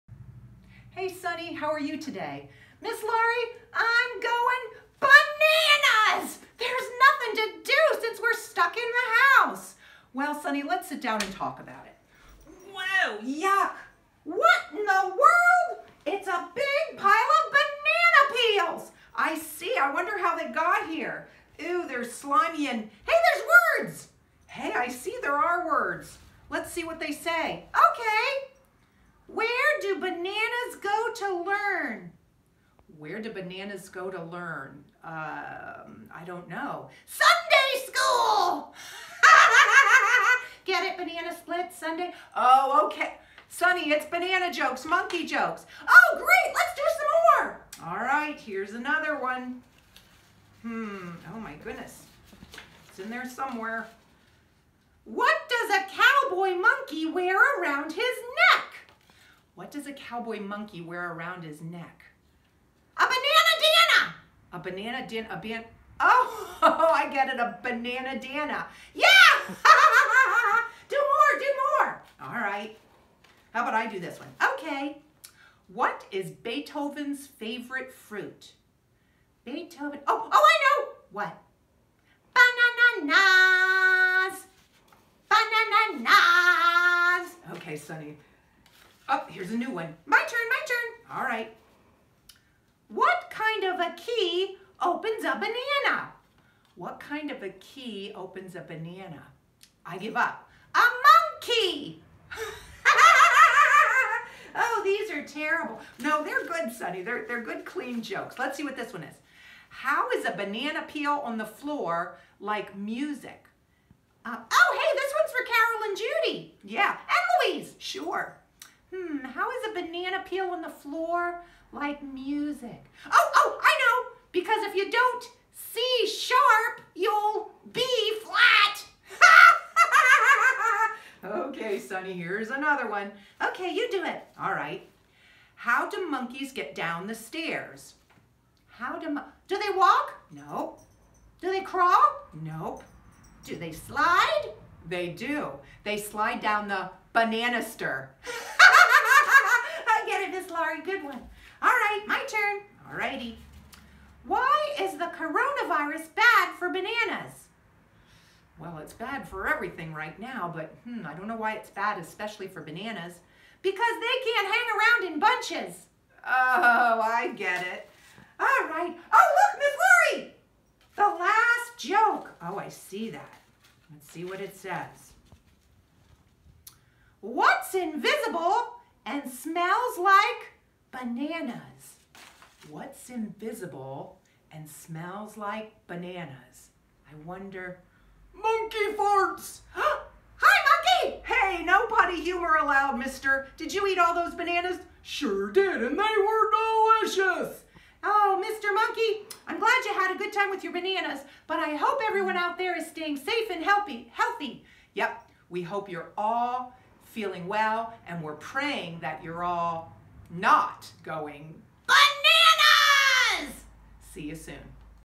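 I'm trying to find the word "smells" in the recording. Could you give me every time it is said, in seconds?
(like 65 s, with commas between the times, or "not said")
179 s, 184 s.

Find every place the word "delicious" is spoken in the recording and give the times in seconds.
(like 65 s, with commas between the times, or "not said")
197 s.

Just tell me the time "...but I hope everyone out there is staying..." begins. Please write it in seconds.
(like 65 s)
201 s.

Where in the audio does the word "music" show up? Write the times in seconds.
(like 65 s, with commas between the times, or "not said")
112 s, 122 s.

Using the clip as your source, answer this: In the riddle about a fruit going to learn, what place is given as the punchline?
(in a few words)
Sunday school.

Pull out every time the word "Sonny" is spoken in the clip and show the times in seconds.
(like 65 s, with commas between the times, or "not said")
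1 s, 10 s, 43 s, 87 s, 106 s, 131 s.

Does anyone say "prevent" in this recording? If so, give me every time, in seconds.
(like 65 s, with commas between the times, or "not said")
not said.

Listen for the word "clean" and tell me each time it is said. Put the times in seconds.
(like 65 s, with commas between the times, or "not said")
107 s.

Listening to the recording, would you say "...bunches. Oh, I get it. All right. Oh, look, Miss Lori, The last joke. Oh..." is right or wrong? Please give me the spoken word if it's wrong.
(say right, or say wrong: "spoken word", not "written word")
right.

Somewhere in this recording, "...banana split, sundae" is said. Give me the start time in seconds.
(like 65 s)
40 s.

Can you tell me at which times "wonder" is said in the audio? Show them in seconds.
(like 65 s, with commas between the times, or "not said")
19 s, 187 s.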